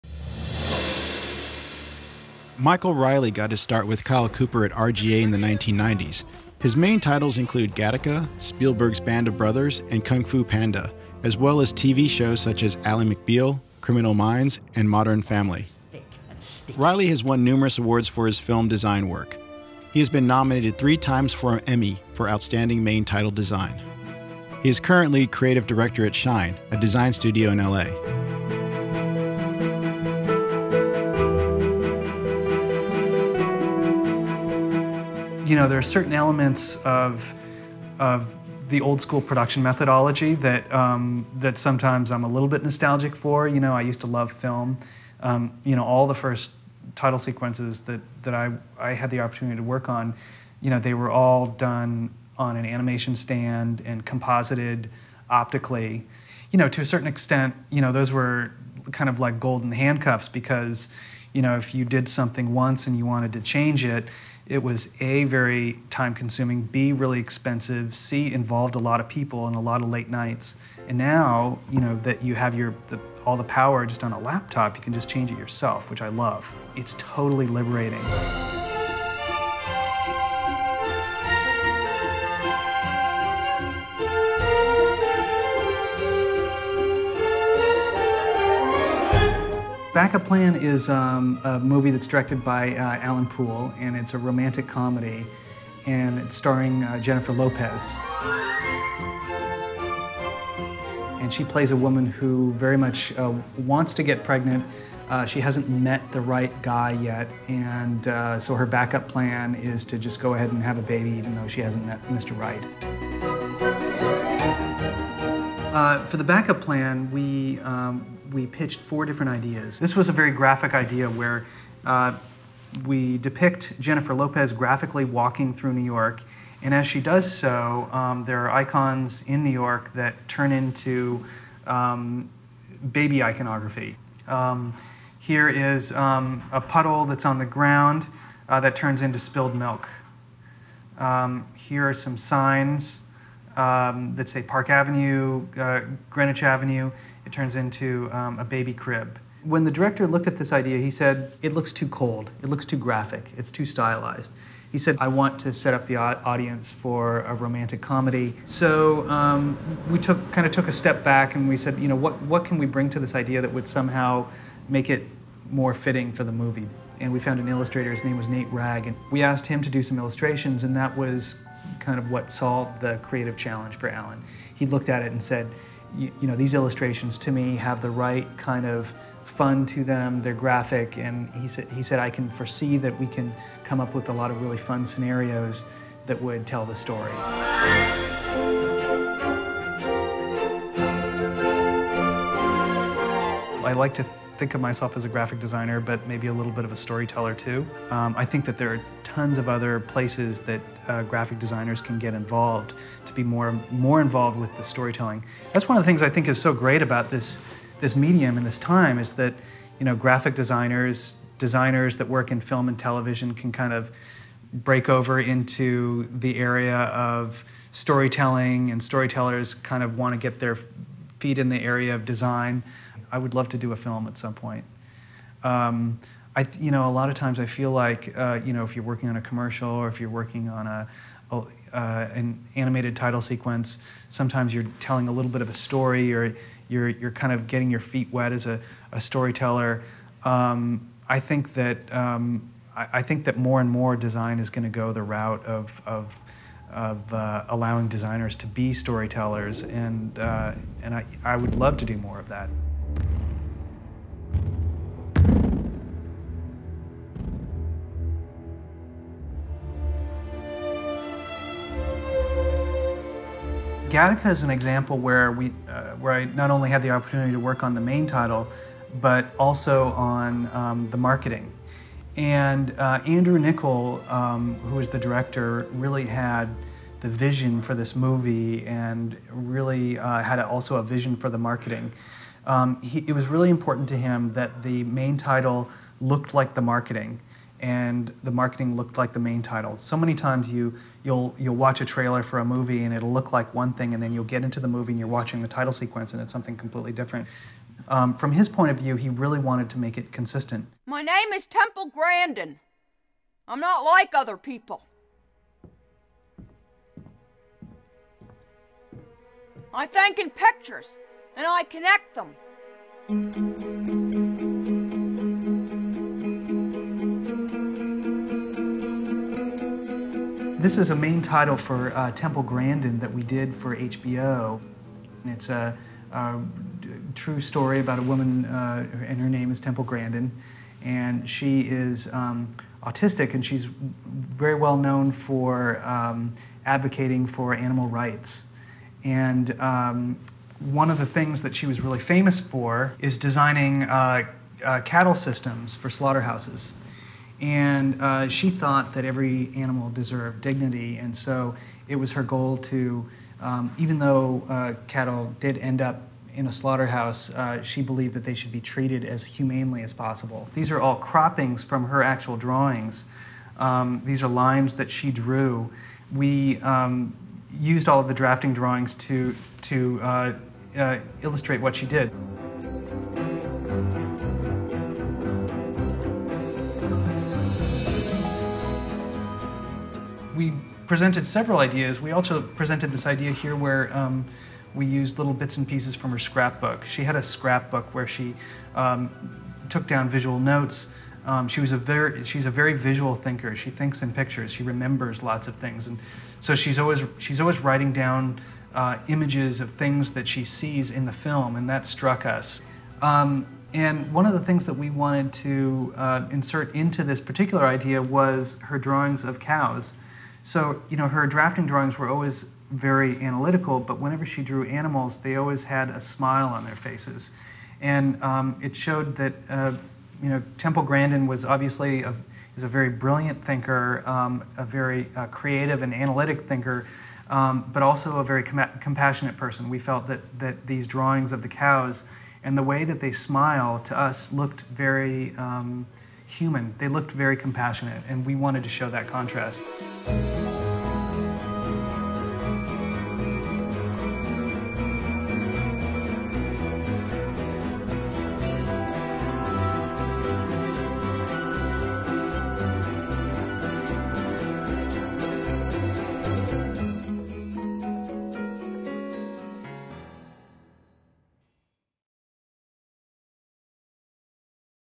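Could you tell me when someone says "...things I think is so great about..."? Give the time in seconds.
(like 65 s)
205 s.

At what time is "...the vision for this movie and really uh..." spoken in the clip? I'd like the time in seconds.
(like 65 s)
277 s.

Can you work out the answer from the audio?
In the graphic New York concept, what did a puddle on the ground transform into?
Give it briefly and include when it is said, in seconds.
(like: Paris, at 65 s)
spilled milk, at 139 s.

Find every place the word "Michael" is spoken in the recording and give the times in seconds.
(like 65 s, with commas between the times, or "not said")
2 s.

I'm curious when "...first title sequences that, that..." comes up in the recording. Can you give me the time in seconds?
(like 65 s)
46 s.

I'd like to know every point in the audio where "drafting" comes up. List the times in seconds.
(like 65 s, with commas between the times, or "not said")
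368 s, 411 s.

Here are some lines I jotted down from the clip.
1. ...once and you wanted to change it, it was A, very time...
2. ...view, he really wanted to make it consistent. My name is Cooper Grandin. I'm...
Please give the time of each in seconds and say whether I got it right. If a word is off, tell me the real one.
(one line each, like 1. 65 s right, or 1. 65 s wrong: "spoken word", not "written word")
1. 62 s right
2. 298 s wrong: "Temple", not "Cooper".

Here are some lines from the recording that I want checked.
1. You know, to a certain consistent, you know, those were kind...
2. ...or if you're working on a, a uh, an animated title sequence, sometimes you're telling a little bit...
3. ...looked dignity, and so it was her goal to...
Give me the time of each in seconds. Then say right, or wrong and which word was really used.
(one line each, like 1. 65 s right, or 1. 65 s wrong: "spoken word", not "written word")
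1. 56 s wrong: "extent", not "consistent"
2. 229 s right
3. 349 s wrong: "deserved", not "looked".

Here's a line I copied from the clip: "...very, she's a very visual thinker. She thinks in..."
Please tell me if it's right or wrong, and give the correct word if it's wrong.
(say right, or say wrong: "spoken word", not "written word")
right.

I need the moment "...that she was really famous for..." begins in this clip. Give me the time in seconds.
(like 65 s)
341 s.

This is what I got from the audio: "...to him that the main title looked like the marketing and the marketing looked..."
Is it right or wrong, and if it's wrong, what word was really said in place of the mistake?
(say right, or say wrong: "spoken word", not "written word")
right.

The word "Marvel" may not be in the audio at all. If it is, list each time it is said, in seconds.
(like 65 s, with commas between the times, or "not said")
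not said.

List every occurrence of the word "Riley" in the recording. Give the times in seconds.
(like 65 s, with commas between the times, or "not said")
2 s, 16 s.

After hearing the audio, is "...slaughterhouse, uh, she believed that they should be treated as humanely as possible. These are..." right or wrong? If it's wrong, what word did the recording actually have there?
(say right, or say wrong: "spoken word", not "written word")
right.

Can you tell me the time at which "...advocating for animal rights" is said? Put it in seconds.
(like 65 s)
336 s.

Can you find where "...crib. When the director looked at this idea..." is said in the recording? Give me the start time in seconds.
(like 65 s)
148 s.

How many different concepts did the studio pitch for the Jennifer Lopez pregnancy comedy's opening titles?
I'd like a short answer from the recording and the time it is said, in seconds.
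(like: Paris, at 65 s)
4, at 118 s.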